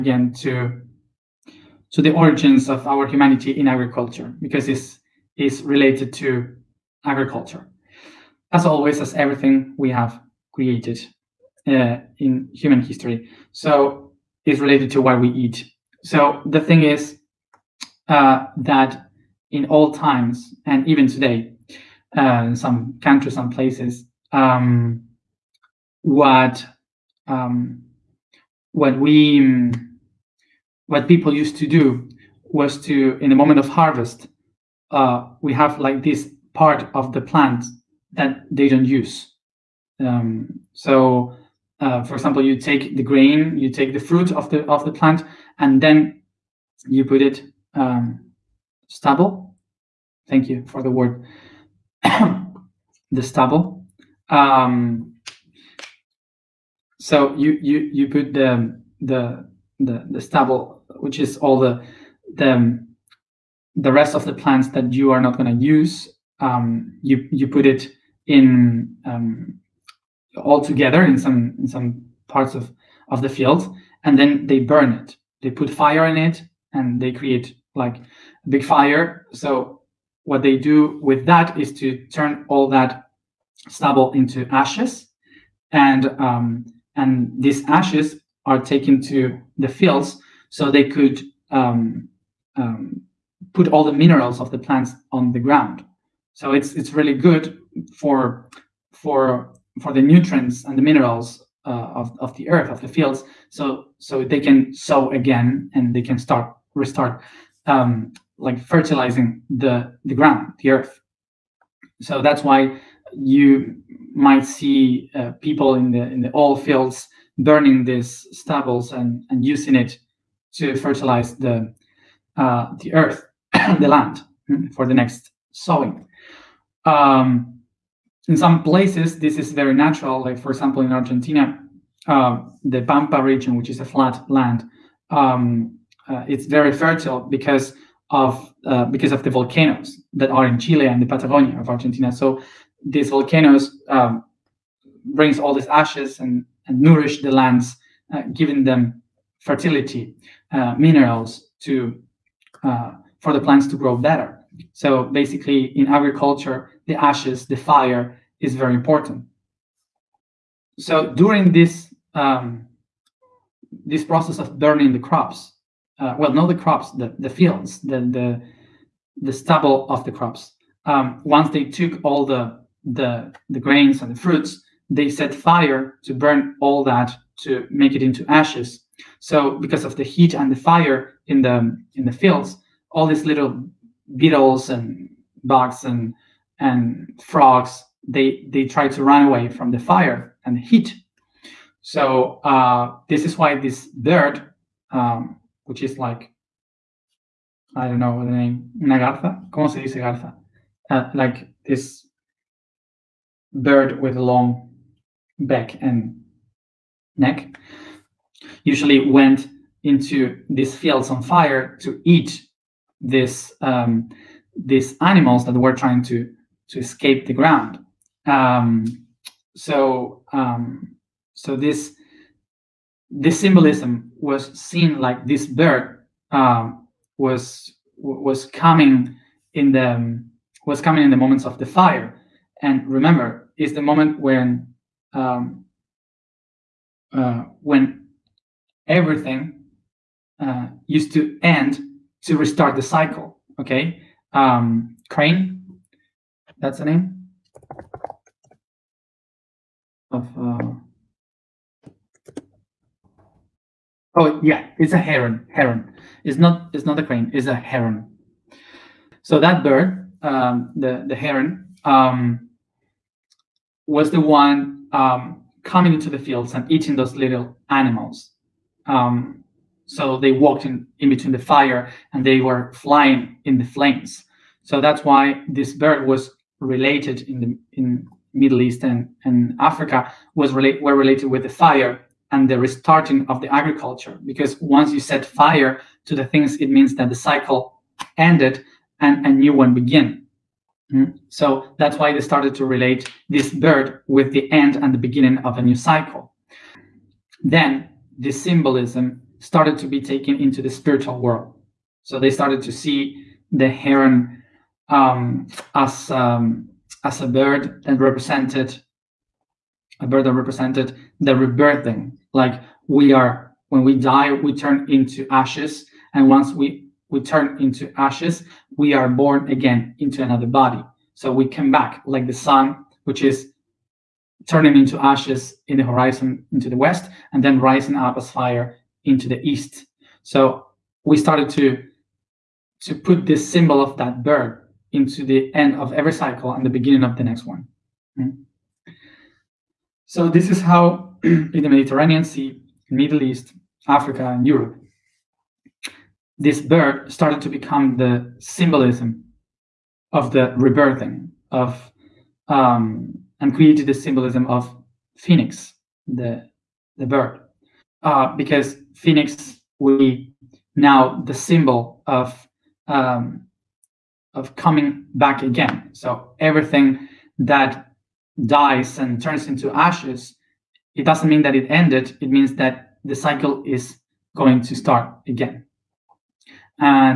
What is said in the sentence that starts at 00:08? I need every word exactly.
As always, as everything we have created uh, in human history.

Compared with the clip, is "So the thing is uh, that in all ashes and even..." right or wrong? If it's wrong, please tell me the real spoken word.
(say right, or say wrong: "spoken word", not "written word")
wrong: "times", not "ashes".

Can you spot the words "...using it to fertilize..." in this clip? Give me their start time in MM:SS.
01:59.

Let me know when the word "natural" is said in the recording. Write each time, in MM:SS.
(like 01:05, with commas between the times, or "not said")
02:09.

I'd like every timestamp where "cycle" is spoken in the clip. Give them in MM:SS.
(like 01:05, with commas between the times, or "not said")
04:02, 04:47, 04:55, 05:36, 06:13.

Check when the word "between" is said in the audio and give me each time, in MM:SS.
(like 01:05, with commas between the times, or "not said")
04:31.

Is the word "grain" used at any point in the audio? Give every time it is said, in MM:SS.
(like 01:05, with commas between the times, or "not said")
00:43, 02:53.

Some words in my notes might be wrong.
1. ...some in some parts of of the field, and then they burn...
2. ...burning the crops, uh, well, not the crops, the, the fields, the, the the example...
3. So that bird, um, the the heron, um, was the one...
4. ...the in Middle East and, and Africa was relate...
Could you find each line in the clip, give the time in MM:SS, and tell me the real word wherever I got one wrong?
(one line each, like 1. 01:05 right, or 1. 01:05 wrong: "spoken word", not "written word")
1. 01:11 right
2. 02:44 wrong: "stubble", not "example"
3. 04:19 right
4. 04:37 right.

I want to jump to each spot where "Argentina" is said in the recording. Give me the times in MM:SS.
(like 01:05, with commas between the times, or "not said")
02:10, 02:21.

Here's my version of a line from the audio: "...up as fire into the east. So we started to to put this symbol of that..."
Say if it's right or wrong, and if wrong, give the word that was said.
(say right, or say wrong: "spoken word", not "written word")
right.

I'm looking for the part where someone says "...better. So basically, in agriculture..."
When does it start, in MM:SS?
02:33.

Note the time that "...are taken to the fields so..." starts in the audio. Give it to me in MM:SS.
01:28.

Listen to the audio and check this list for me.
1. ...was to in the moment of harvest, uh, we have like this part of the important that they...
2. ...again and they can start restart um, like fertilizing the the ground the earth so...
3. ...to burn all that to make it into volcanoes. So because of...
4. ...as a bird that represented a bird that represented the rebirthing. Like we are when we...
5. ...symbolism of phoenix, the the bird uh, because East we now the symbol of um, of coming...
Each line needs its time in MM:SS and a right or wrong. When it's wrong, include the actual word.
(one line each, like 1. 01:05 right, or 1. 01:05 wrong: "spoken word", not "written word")
1. 00:32 wrong: "plant", not "important"
2. 01:45 right
3. 02:56 wrong: "ashes", not "volcanoes"
4. 05:07 right
5. 05:53 wrong: "Phoenix", not "East".